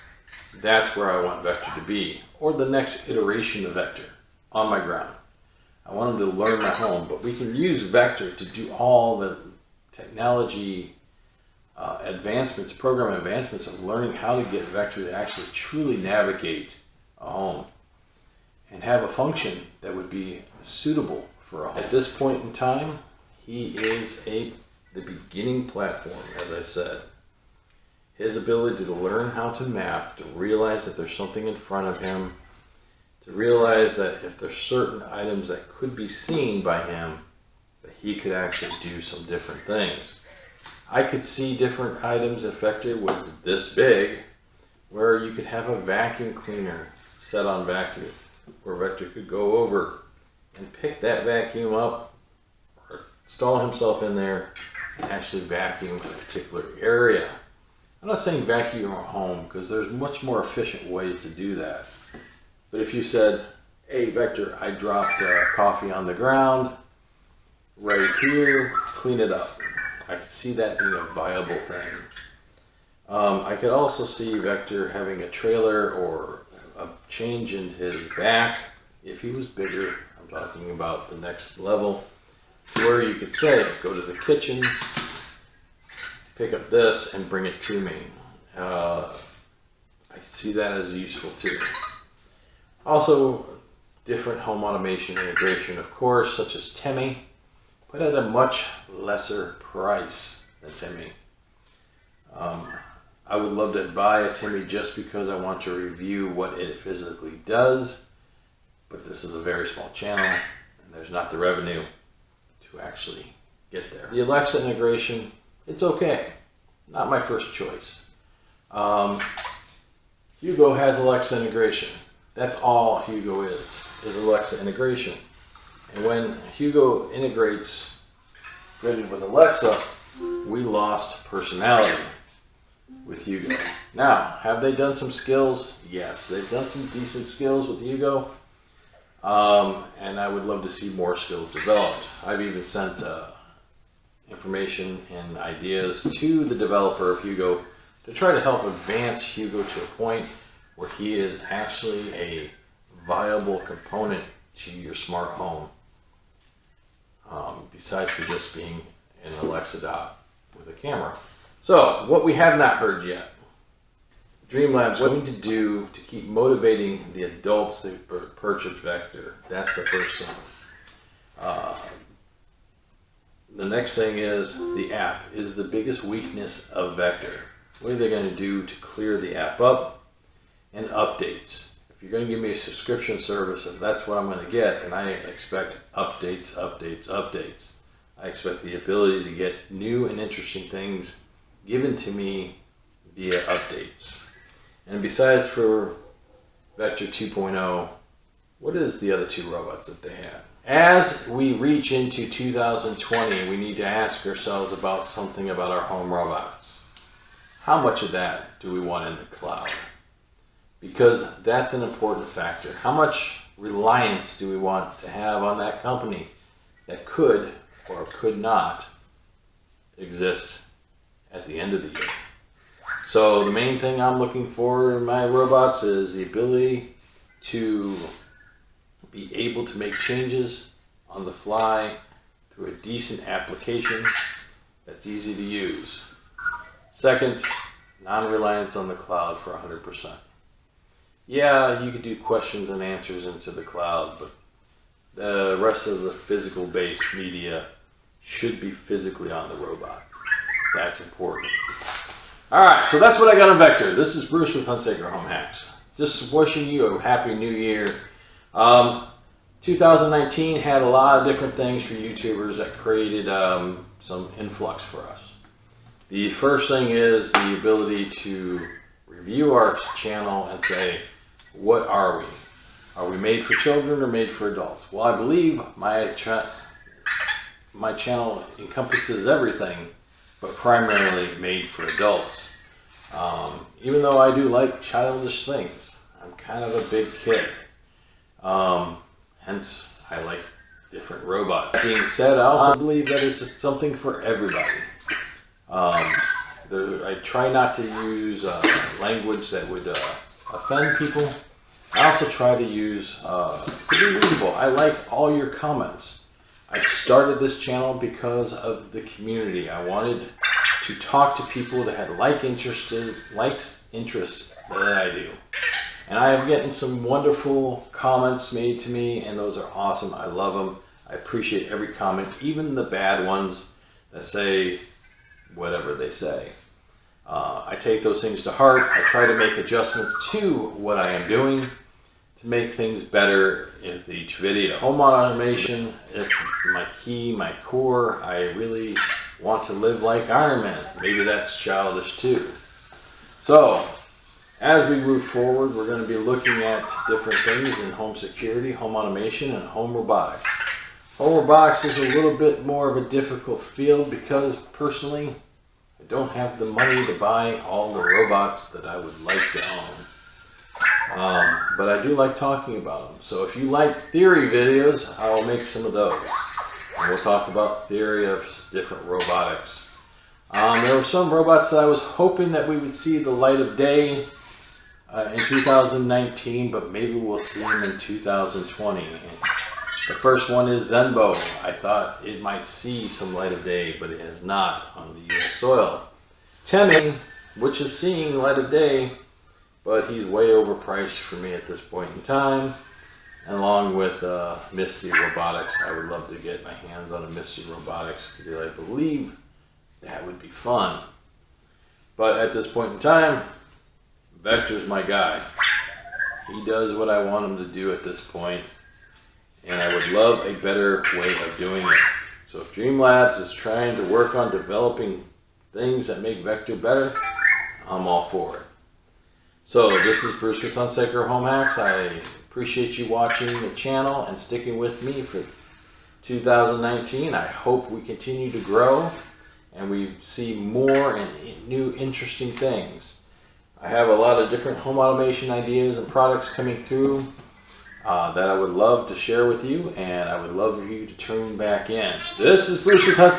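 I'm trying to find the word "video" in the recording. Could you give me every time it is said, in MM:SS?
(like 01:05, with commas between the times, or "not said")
05:34, 06:04.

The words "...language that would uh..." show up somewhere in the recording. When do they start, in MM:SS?
04:58.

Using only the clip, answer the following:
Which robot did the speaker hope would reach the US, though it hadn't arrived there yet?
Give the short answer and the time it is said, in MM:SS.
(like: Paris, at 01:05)
Zenbo, at 06:20.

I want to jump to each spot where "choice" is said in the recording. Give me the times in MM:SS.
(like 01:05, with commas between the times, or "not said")
01:57.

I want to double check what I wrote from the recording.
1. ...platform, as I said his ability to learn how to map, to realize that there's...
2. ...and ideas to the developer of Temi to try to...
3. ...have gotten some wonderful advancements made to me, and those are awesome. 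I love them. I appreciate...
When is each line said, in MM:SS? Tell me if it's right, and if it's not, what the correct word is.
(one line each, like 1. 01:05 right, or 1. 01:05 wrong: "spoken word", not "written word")
1. 00:25 right
2. 02:25 wrong: "Hugo", not "Temi"
3. 05:16 wrong: "comments", not "advancements".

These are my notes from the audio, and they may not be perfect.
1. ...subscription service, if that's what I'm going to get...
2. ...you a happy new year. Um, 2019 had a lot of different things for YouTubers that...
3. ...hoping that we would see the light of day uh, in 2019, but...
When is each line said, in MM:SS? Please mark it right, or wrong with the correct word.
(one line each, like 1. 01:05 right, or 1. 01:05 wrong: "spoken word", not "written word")
1. 03:02 right
2. 04:16 right
3. 06:11 right.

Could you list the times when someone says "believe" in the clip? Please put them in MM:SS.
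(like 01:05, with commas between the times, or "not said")
04:35, 04:52, 06:38.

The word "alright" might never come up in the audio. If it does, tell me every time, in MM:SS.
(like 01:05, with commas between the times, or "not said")
not said.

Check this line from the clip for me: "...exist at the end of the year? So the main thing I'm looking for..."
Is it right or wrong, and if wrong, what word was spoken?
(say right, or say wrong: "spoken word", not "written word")
right.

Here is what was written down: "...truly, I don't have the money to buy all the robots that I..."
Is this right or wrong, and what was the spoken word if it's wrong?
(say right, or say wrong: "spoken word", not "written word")
wrong: "personally", not "truly".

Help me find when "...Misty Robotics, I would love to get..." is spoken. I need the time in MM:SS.
06:34.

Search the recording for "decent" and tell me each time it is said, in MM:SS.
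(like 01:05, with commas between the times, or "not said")
02:16, 03:52.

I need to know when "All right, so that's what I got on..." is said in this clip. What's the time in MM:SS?
04:12.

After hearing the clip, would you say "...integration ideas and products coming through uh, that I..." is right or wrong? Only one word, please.
wrong.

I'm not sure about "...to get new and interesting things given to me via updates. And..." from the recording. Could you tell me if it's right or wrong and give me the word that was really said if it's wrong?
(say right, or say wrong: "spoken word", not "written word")
right.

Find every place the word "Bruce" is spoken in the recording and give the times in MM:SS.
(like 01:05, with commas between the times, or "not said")
04:14, 07:00, 07:22.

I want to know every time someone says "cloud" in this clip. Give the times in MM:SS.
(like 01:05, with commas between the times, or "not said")
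03:29, 03:58, 04:03.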